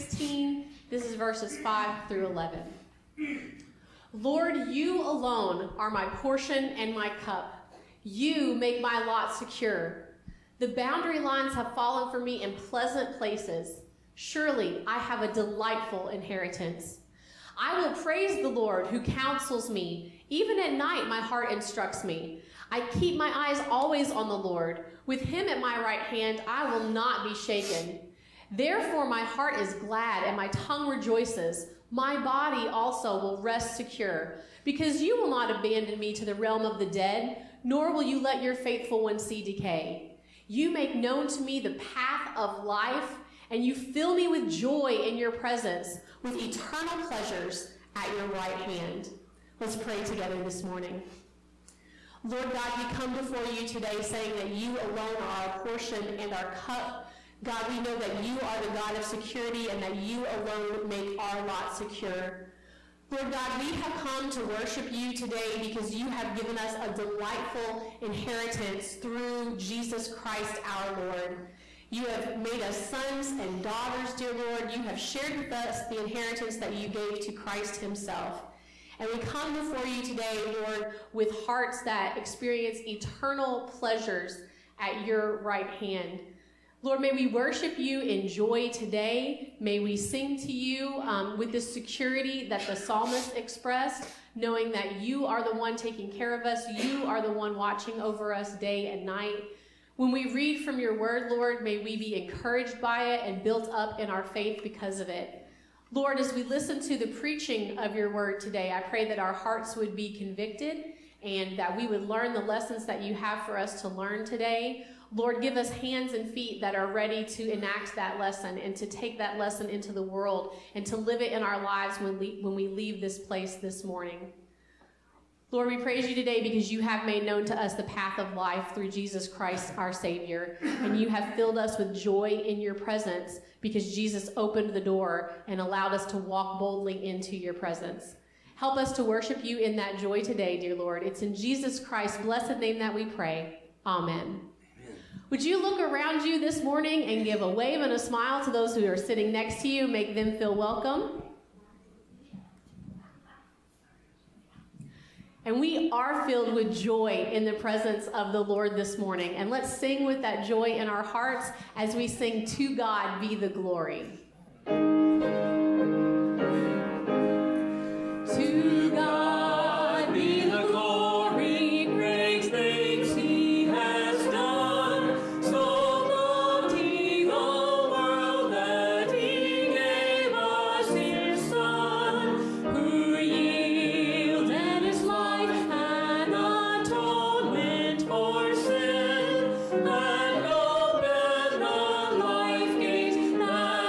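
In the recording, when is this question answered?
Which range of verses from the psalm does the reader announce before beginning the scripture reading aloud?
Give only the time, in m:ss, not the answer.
0:01.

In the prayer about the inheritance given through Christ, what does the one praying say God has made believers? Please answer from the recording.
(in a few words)
sons and daughters.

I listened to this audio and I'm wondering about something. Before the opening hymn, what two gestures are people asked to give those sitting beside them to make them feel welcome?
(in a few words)
a wave and a smile.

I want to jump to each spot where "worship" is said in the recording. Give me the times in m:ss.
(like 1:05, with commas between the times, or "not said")
1:04, 1:27, 2:19.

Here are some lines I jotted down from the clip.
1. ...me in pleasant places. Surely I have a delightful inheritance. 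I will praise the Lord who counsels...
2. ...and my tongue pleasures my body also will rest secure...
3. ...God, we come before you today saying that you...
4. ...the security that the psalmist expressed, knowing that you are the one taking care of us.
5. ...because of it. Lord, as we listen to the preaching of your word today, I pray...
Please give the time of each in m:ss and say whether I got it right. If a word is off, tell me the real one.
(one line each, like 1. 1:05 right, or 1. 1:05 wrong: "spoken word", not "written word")
1. 0:12 right
2. 0:30 wrong: "rejoices", not "pleasures"
3. 0:52 right
4. 1:31 right
5. 1:44 right.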